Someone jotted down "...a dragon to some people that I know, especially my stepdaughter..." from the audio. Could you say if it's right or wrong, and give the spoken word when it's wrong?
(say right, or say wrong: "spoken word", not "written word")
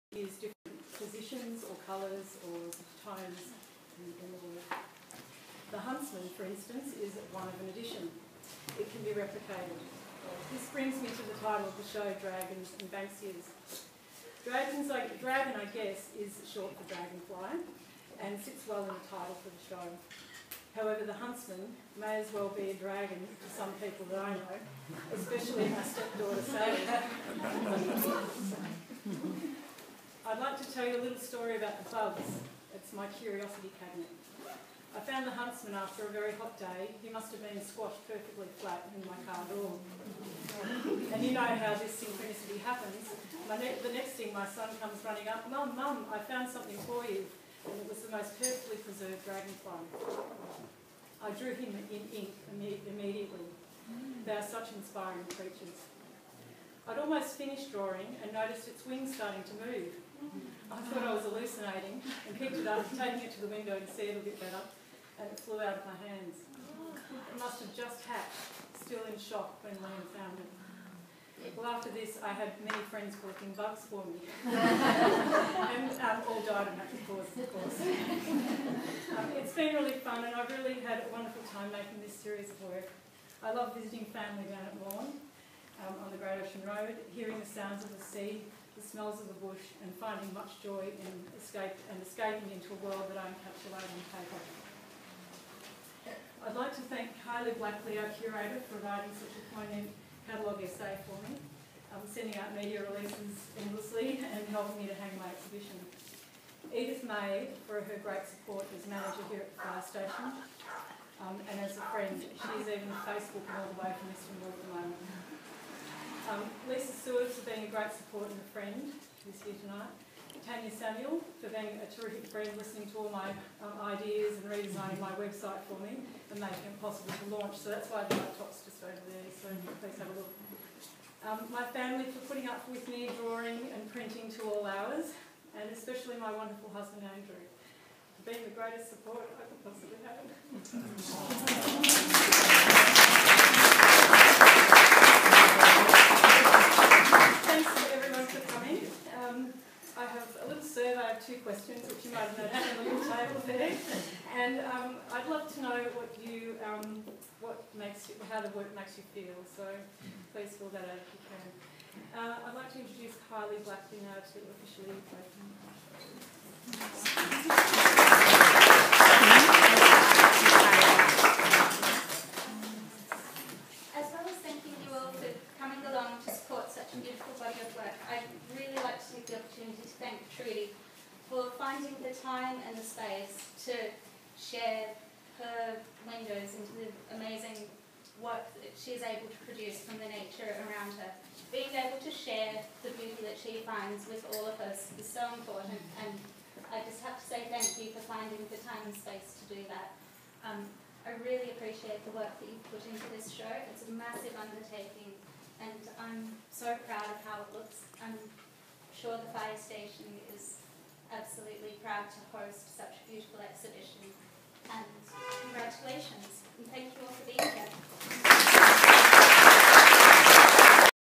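right.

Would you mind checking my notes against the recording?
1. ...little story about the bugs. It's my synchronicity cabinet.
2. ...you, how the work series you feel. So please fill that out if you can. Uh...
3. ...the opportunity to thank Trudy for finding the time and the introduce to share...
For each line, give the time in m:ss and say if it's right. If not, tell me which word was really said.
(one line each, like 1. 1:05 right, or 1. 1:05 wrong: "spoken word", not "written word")
1. 0:31 wrong: "curiosity", not "synchronicity"
2. 2:38 wrong: "makes", not "series"
3. 2:59 wrong: "space", not "introduce".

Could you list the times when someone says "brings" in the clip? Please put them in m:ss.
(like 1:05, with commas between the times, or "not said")
0:10.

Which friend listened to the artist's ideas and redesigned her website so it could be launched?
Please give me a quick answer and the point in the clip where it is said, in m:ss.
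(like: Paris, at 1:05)
Tanya Samuel, at 2:00.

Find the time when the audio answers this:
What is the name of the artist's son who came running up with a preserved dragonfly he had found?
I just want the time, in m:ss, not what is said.
1:09.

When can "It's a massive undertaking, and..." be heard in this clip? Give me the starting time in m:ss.
3:23.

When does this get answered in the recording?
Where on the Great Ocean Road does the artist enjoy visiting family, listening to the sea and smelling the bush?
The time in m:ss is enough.
1:24.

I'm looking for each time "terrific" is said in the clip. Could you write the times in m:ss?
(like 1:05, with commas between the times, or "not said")
2:01.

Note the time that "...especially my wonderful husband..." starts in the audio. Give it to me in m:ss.
2:15.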